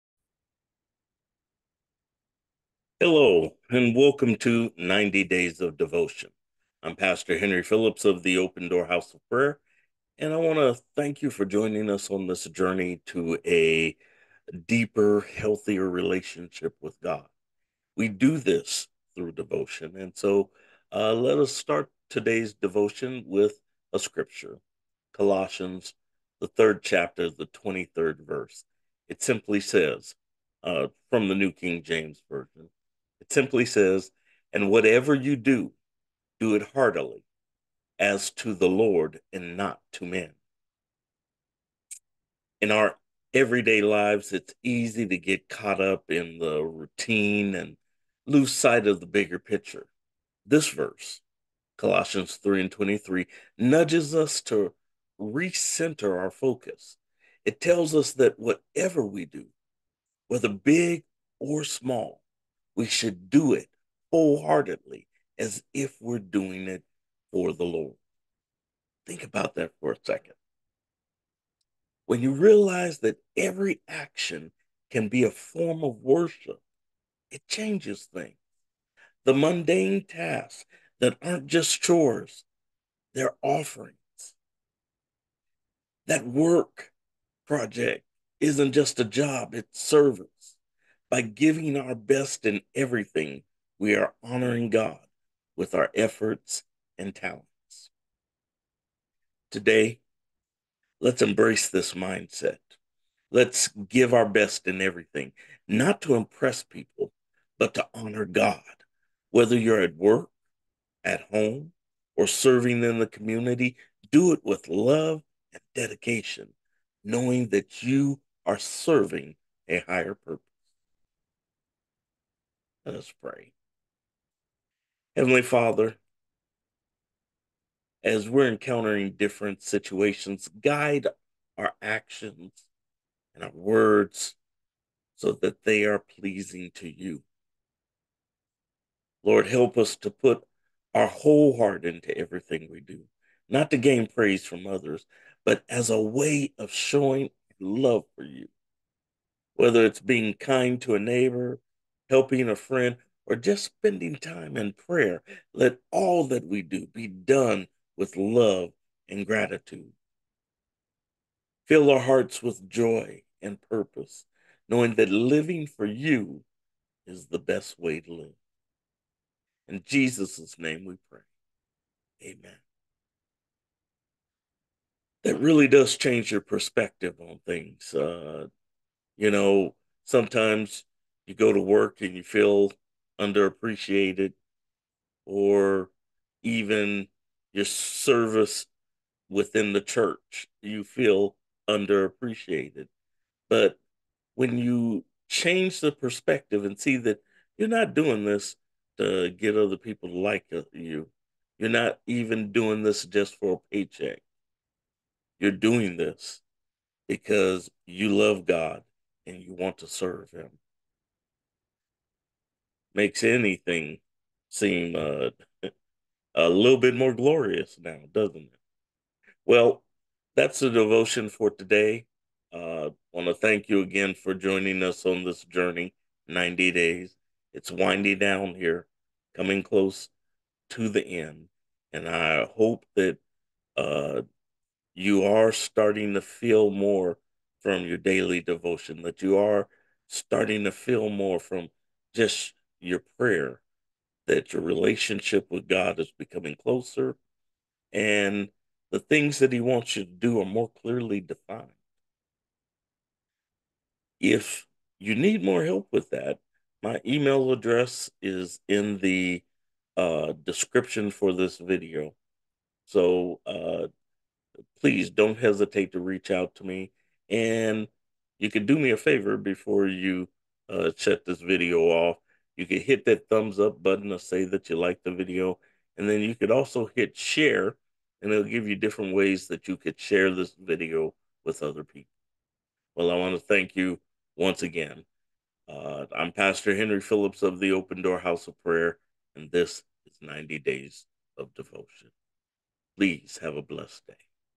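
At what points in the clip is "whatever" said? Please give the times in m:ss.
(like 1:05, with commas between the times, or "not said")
0:34, 0:58.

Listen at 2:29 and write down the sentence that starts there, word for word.
Whether it's being kind to a neighbor, helping a friend, or just spending time in prayer.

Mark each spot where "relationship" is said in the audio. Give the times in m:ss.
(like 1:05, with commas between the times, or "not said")
0:15, 4:04.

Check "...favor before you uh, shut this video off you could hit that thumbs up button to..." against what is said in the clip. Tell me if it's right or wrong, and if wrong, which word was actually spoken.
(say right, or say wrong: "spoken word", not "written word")
right.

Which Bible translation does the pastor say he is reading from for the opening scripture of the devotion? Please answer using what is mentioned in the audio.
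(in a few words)
New King James Version.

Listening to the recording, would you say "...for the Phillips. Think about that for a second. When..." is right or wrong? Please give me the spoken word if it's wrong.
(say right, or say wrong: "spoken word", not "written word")
wrong: "Lord", not "Phillips".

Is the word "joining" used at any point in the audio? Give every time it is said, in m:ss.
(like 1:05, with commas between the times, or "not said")
0:11, 3:44.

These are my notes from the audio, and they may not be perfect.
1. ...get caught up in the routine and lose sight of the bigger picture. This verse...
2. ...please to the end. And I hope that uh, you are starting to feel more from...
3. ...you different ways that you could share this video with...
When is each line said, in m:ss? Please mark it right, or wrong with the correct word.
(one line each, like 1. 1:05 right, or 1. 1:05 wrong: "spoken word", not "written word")
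1. 0:45 right
2. 3:49 wrong: "close", not "please"
3. 4:38 right.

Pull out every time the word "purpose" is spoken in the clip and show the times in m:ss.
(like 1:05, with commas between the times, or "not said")
2:00, 2:43.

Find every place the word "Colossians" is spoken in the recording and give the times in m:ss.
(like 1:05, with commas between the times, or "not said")
0:25, 0:51.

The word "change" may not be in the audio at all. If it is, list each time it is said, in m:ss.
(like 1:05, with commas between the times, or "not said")
1:17, 2:55, 3:15.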